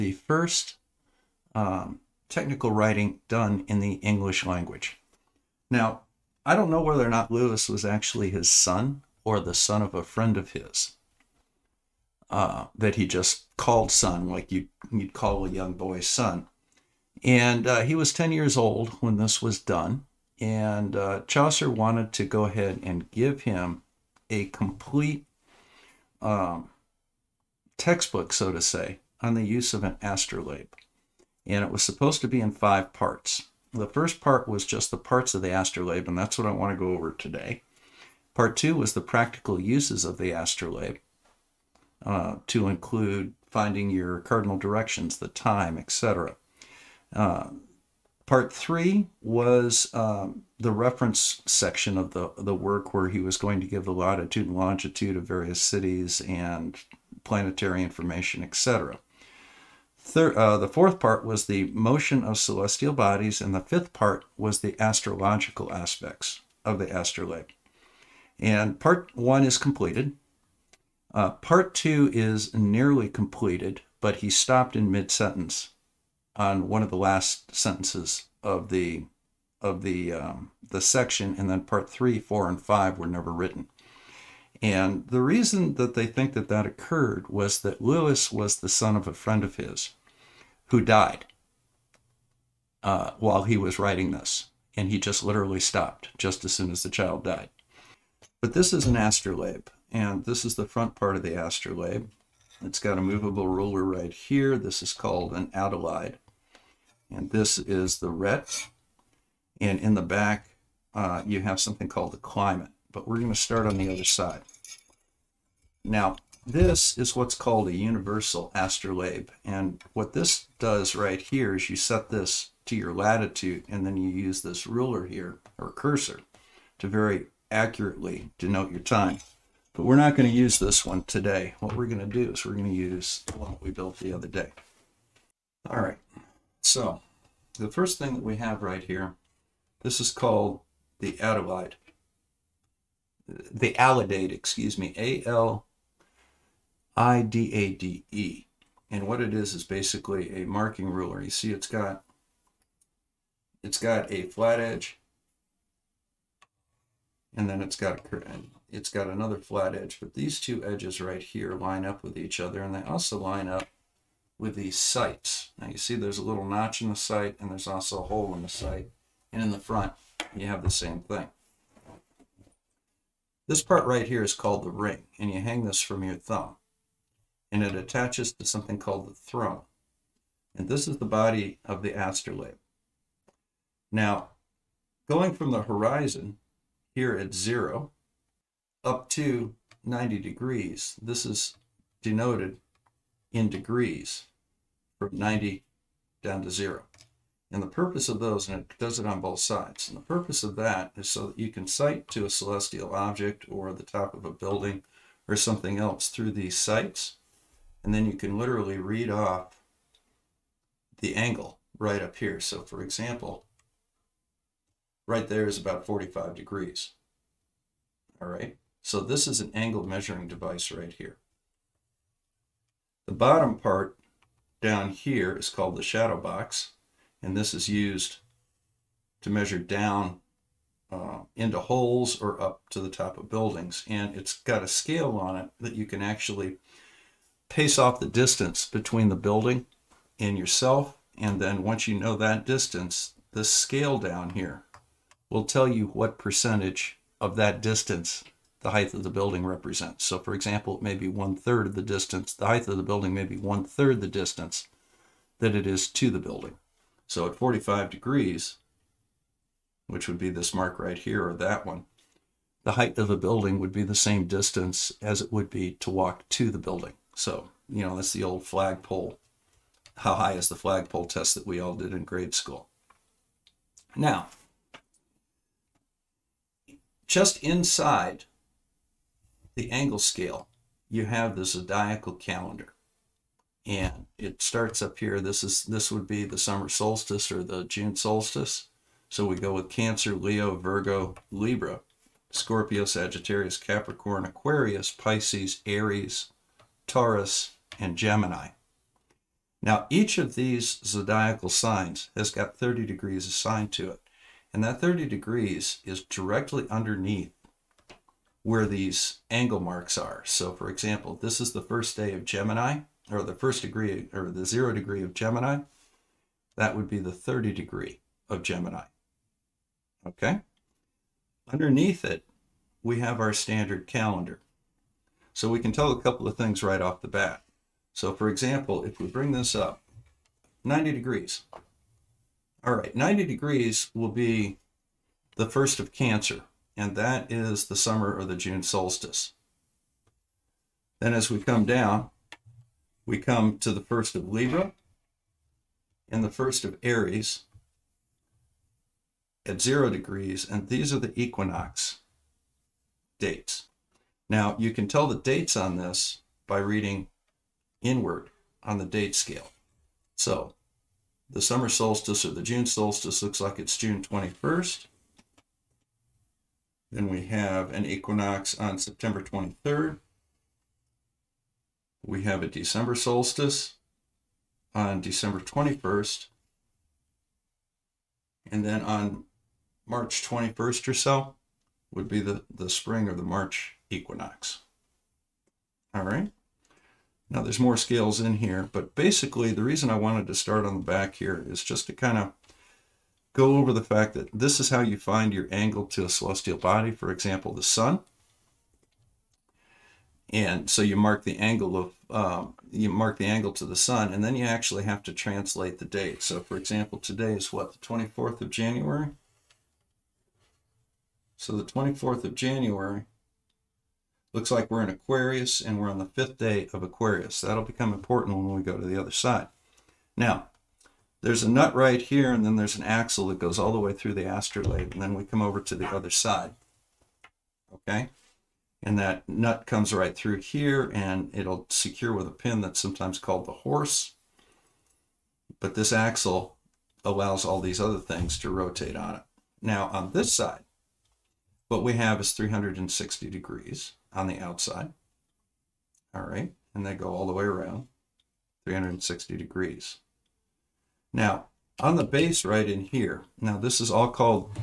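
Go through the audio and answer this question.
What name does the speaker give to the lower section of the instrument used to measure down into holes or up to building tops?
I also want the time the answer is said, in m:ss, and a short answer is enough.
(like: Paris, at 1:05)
shadow box, at 3:45.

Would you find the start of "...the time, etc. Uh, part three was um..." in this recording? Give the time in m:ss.
0:45.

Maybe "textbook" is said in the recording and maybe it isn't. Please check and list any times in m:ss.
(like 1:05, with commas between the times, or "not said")
0:27.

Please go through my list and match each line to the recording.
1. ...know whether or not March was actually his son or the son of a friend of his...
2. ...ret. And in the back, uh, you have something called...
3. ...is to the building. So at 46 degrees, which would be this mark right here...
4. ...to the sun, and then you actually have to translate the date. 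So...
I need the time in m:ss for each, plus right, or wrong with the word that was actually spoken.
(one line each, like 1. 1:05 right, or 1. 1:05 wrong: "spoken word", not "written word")
1. 0:06 wrong: "Lewis", not "March"
2. 1:48 right
3. 4:15 wrong: "45", not "46"
4. 6:43 right.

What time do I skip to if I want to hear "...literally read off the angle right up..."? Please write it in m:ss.
3:28.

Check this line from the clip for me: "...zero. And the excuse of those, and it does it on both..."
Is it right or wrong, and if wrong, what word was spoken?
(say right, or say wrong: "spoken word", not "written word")
wrong: "purpose", not "excuse".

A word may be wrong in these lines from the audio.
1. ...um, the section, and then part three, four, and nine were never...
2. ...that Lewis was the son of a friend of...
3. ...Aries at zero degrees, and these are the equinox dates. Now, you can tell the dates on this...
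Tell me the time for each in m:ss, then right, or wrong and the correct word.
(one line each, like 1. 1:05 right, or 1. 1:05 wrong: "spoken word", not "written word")
1. 1:20 wrong: "five", not "nine"
2. 1:27 right
3. 5:46 right.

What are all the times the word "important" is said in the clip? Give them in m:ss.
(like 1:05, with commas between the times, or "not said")
6:57.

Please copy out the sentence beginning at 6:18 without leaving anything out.
And then on March 21st or so would be the, the spring or the March equinox.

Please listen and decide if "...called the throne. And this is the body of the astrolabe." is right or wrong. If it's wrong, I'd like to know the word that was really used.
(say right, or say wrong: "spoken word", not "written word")
right.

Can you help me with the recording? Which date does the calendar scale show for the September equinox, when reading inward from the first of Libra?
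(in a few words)
September 23.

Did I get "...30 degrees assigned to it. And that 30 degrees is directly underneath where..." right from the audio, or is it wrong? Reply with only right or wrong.
right.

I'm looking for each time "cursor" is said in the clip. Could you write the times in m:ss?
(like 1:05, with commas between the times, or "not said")
2:05.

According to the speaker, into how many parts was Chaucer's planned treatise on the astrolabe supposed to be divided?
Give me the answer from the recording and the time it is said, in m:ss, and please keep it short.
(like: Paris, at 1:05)
5, at 0:32.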